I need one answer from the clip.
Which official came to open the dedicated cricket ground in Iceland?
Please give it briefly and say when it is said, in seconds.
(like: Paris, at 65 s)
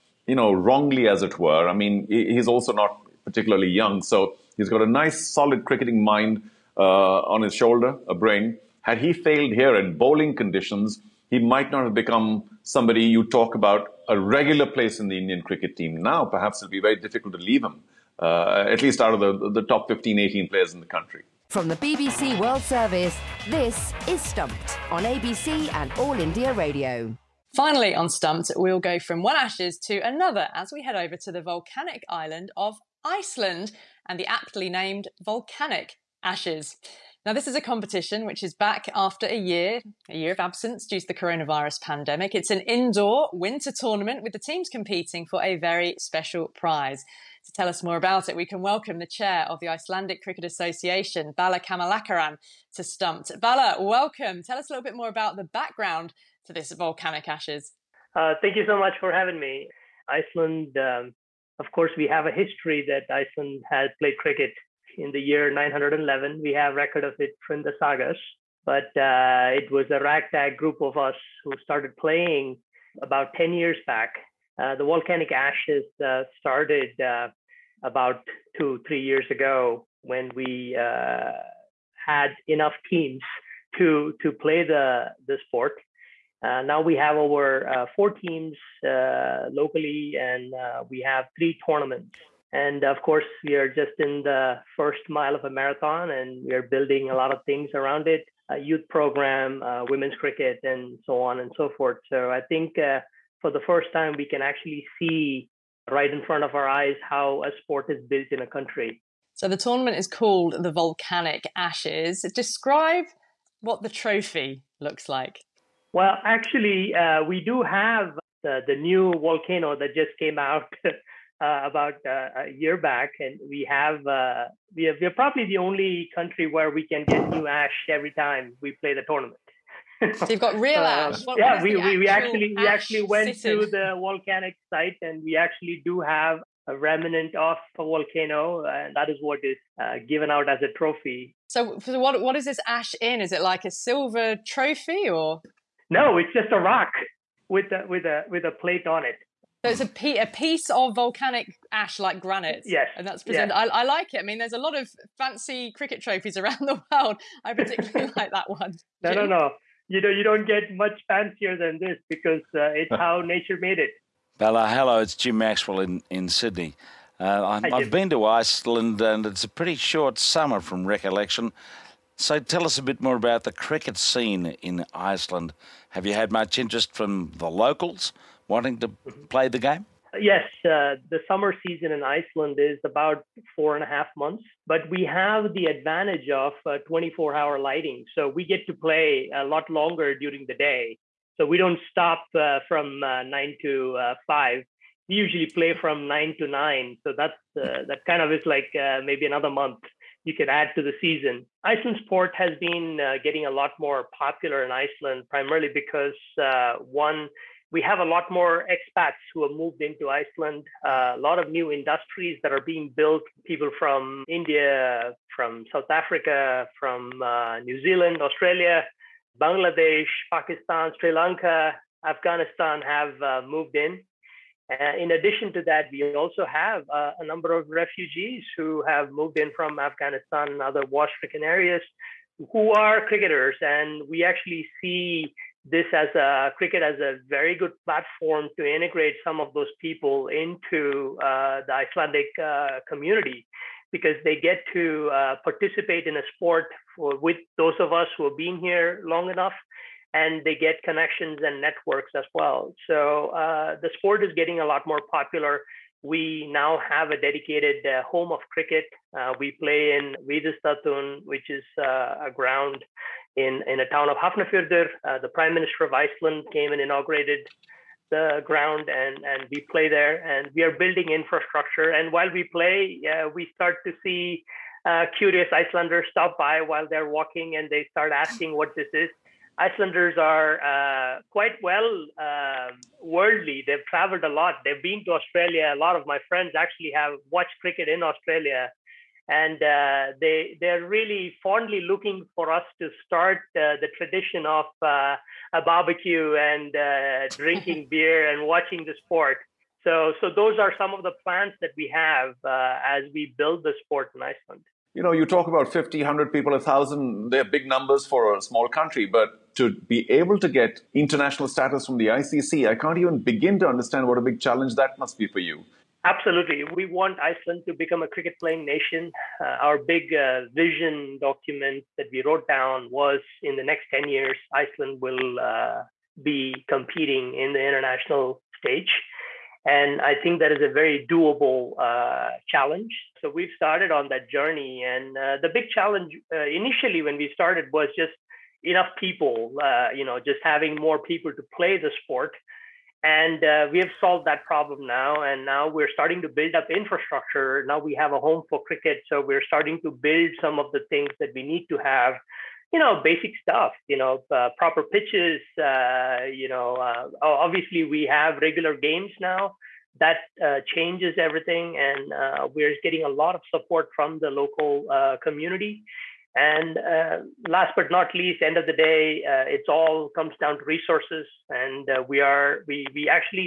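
The Prime Minister of Iceland, at 265 s.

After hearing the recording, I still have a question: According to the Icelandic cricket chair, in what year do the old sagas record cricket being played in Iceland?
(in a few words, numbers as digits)
911.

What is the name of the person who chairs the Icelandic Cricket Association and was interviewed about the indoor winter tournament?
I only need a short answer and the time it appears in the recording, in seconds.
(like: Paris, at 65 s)
Bala Kamalakaran, at 51 s.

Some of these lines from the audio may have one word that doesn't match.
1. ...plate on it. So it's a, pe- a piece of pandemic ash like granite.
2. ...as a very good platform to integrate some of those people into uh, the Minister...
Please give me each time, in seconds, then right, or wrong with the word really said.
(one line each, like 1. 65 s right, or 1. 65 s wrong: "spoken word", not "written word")
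1. 148 s wrong: "volcanic", not "pandemic"
2. 236 s wrong: "Icelandic", not "Minister".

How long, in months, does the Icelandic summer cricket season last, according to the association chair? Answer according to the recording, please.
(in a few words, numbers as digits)
4 and a half months.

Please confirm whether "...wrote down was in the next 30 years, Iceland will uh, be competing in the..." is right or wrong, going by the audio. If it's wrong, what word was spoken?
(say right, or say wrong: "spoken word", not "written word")
wrong: "10", not "30".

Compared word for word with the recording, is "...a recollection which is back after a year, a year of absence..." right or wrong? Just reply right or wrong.
wrong.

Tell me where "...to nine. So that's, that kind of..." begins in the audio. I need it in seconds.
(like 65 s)
196 s.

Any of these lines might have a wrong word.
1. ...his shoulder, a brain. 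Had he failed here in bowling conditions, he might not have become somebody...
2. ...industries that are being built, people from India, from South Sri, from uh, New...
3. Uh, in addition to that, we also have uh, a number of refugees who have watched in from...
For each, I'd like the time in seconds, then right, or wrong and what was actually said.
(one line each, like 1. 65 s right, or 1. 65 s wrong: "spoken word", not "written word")
1. 7 s right
2. 211 s wrong: "Africa", not "Sri"
3. 224 s wrong: "moved", not "watched".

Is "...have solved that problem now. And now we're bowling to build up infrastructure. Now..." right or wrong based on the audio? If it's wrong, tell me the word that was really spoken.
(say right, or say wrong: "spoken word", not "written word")
wrong: "starting", not "bowling".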